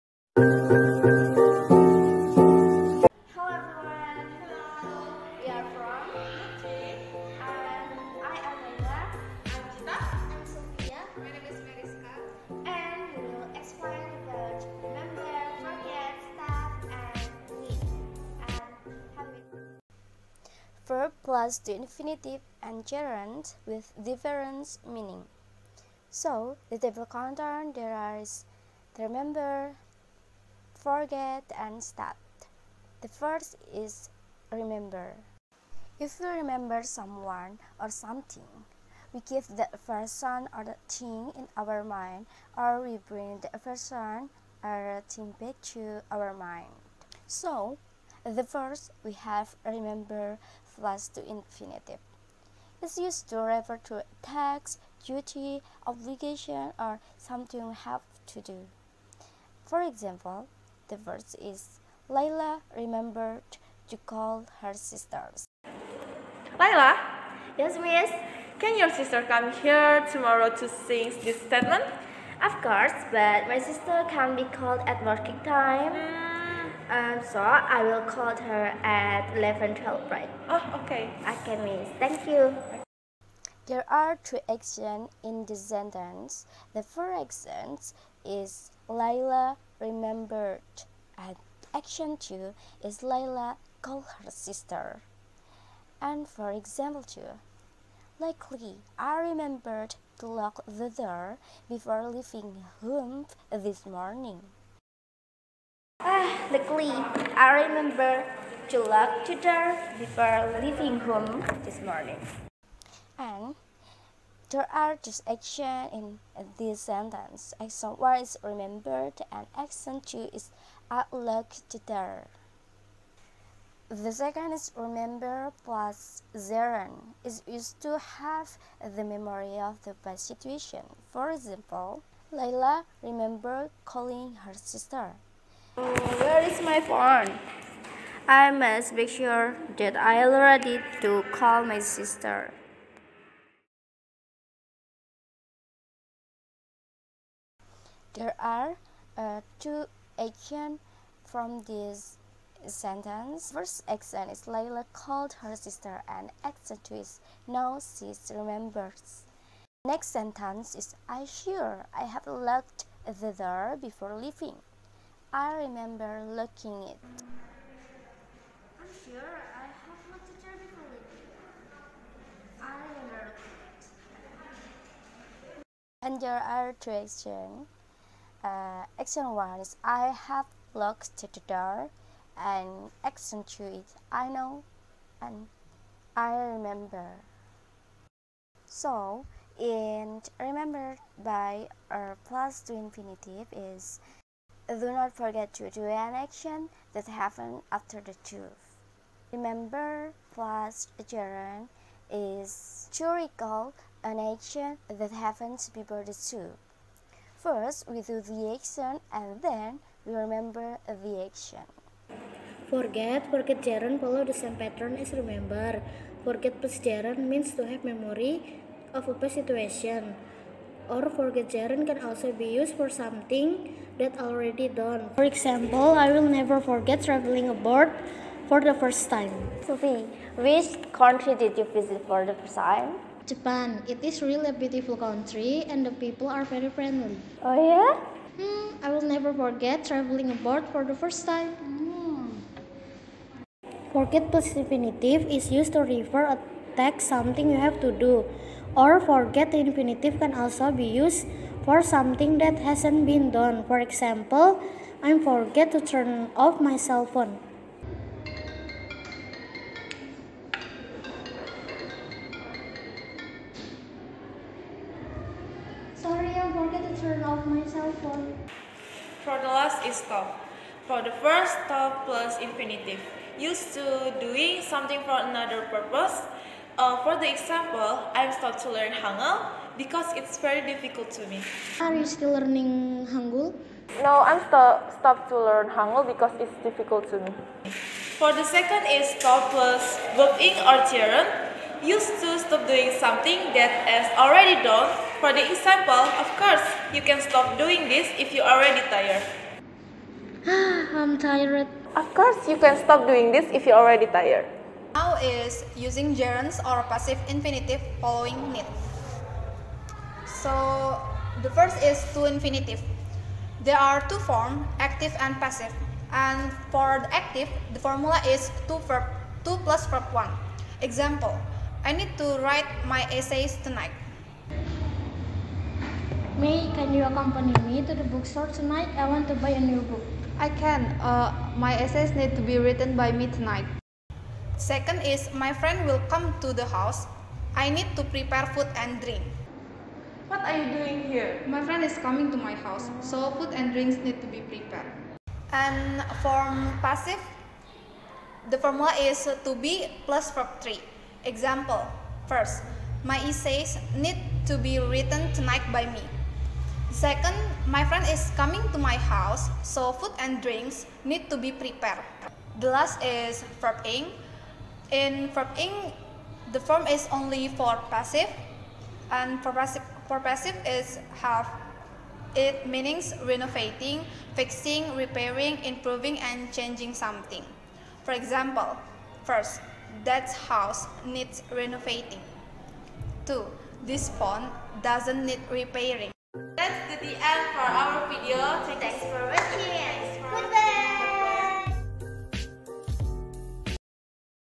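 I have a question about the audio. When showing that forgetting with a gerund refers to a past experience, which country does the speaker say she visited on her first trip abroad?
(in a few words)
Japan.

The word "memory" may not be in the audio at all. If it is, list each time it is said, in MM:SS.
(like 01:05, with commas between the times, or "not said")
02:09, 03:37.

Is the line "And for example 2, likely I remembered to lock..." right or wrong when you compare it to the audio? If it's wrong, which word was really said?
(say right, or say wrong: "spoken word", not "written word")
right.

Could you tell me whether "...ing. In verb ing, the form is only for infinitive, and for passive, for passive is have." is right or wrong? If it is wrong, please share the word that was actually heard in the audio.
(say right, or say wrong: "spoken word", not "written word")
wrong: "passive", not "infinitive".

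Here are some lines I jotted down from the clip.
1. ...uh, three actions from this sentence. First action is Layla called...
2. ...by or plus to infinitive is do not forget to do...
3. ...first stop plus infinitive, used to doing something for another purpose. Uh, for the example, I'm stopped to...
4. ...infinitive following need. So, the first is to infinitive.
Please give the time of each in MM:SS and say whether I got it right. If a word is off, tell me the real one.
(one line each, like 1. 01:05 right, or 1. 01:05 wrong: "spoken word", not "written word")
1. 02:29 wrong: "two", not "three"
2. 03:11 right
3. 04:31 right
4. 05:07 right.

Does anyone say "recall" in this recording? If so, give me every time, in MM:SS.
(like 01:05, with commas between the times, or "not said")
03:23.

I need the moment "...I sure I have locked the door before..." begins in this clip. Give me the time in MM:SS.
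02:41.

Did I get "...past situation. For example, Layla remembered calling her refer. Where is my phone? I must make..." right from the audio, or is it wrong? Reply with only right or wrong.
wrong.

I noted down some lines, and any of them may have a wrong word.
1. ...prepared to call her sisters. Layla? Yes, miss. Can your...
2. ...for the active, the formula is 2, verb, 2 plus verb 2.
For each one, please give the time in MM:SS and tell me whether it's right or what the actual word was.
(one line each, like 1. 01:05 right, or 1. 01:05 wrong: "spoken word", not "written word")
1. 01:02 wrong: "remembered", not "prepared"
2. 05:16 wrong: "1", not "2".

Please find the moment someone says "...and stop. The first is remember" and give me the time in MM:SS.
00:31.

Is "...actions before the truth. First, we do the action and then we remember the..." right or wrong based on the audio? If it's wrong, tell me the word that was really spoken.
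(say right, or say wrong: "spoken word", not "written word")
wrong: "happens", not "actions".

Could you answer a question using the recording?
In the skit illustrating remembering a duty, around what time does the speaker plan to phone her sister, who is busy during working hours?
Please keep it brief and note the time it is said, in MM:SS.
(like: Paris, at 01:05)
11 12, at 01:19.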